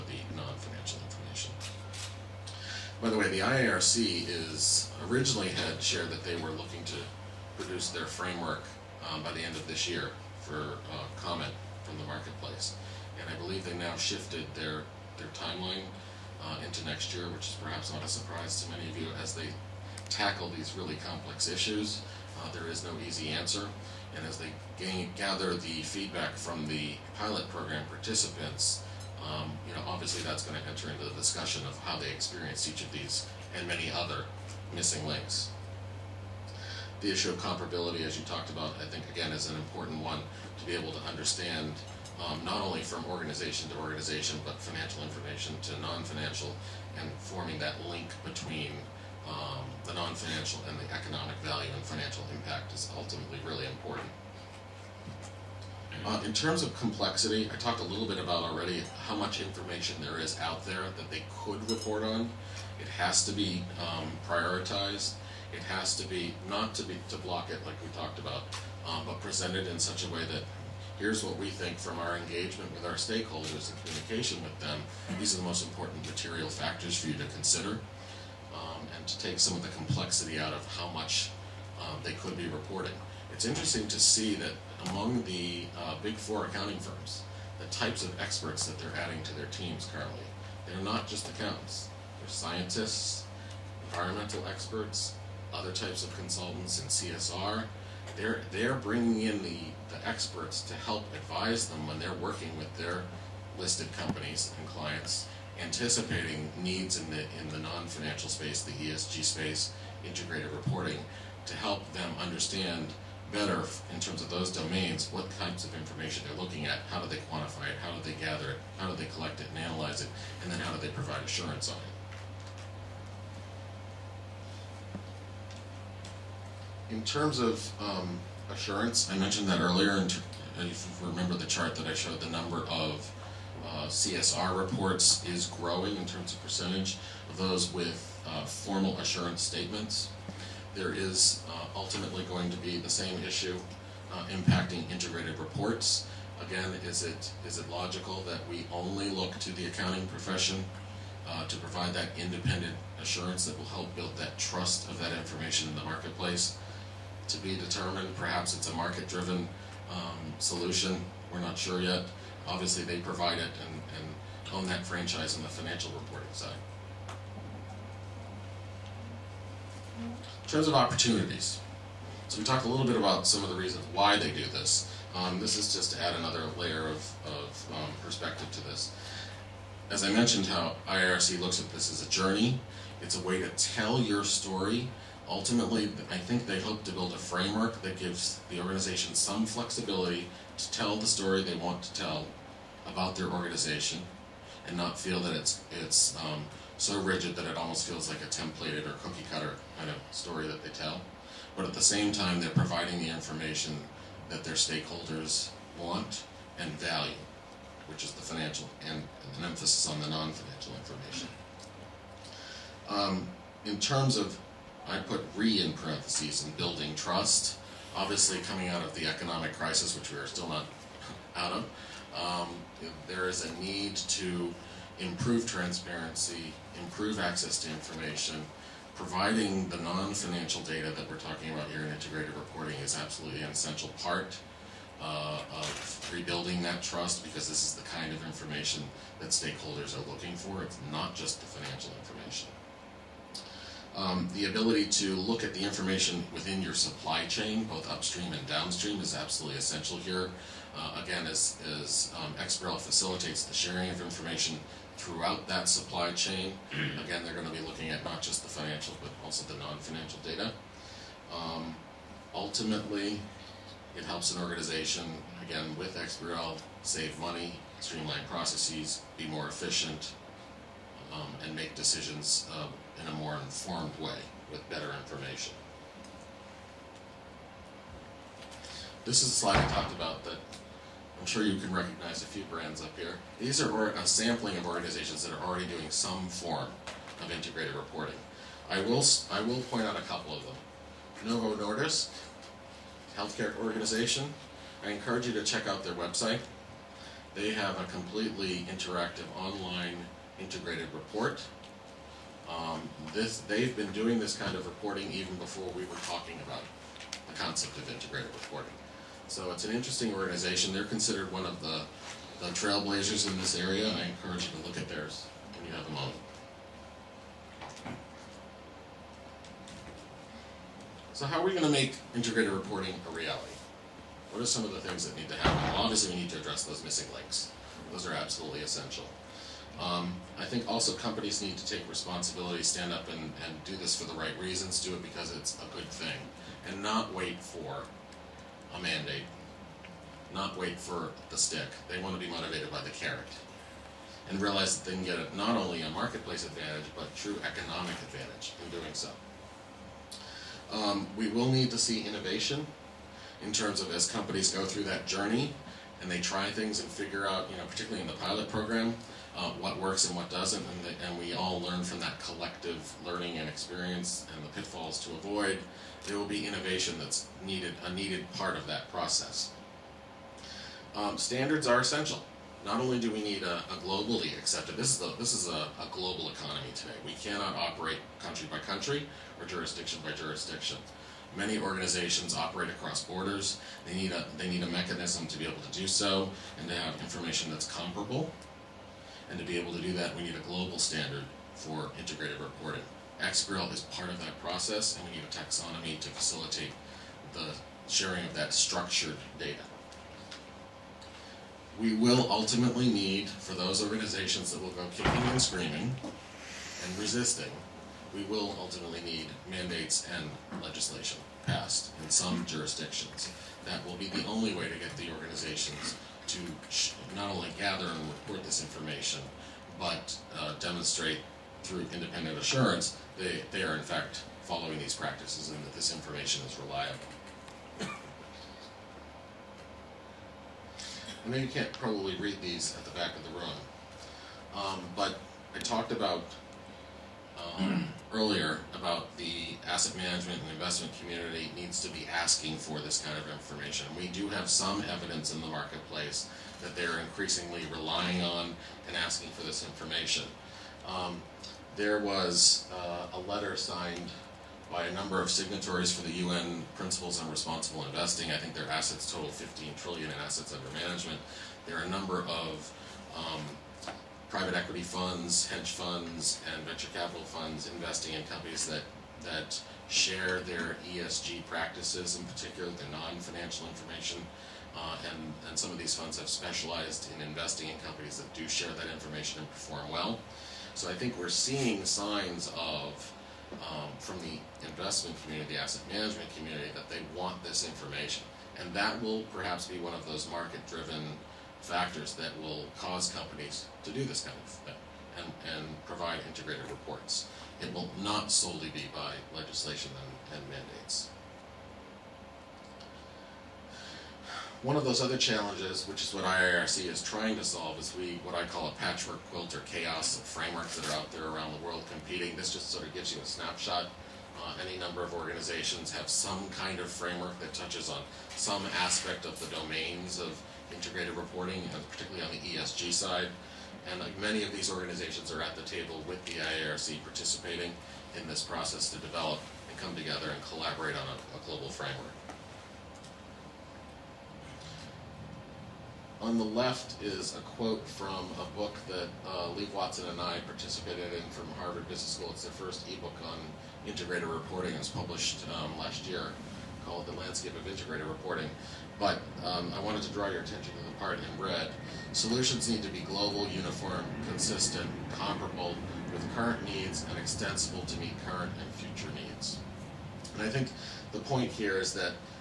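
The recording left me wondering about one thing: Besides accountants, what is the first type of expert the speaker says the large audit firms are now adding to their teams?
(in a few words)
scientists.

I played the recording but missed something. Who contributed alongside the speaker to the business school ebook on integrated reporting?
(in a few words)
Liv Watson.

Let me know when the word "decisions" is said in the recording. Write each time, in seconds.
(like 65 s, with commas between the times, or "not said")
271 s.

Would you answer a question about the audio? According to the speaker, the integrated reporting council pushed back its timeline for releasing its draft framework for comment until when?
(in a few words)
next year.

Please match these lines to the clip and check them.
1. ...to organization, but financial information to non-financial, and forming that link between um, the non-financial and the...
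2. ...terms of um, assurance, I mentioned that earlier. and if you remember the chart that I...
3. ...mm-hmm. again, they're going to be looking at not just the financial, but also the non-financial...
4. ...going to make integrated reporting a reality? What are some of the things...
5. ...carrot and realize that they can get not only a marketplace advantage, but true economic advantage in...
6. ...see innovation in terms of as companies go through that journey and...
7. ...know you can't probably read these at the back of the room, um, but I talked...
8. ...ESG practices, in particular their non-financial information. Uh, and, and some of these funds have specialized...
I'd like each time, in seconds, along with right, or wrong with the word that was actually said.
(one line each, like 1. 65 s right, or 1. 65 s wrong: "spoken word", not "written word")
1. 43 s right
2. 127 s right
3. 256 s right
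4. 321 s right
5. 342 s right
6. 351 s right
7. 431 s right
8. 470 s right.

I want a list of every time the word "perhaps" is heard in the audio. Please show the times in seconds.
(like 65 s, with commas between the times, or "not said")
17 s, 158 s, 489 s.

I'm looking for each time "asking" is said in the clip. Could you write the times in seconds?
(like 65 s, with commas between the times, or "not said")
442 s, 448 s.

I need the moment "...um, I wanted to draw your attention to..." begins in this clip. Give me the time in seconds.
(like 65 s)
549 s.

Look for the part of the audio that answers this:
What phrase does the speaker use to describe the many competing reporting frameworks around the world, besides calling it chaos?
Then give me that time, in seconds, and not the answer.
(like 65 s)
508 s.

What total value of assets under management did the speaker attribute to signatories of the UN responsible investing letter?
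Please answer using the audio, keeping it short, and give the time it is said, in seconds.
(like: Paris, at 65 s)
15 trillion, at 459 s.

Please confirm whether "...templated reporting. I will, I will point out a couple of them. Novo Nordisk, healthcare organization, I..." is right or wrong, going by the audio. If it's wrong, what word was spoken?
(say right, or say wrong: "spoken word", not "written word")
wrong: "integrated", not "templated".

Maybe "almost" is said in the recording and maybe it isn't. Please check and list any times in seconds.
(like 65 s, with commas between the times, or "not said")
197 s.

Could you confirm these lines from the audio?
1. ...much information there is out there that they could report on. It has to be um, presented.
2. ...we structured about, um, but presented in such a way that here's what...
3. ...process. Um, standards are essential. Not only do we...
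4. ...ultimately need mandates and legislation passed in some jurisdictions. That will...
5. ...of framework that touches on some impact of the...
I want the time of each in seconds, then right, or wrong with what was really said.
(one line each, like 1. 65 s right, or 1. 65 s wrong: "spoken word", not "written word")
1. 59 s wrong: "prioritized", not "presented"
2. 67 s wrong: "talked", not "structured"
3. 368 s right
4. 408 s right
5. 516 s wrong: "aspect", not "impact".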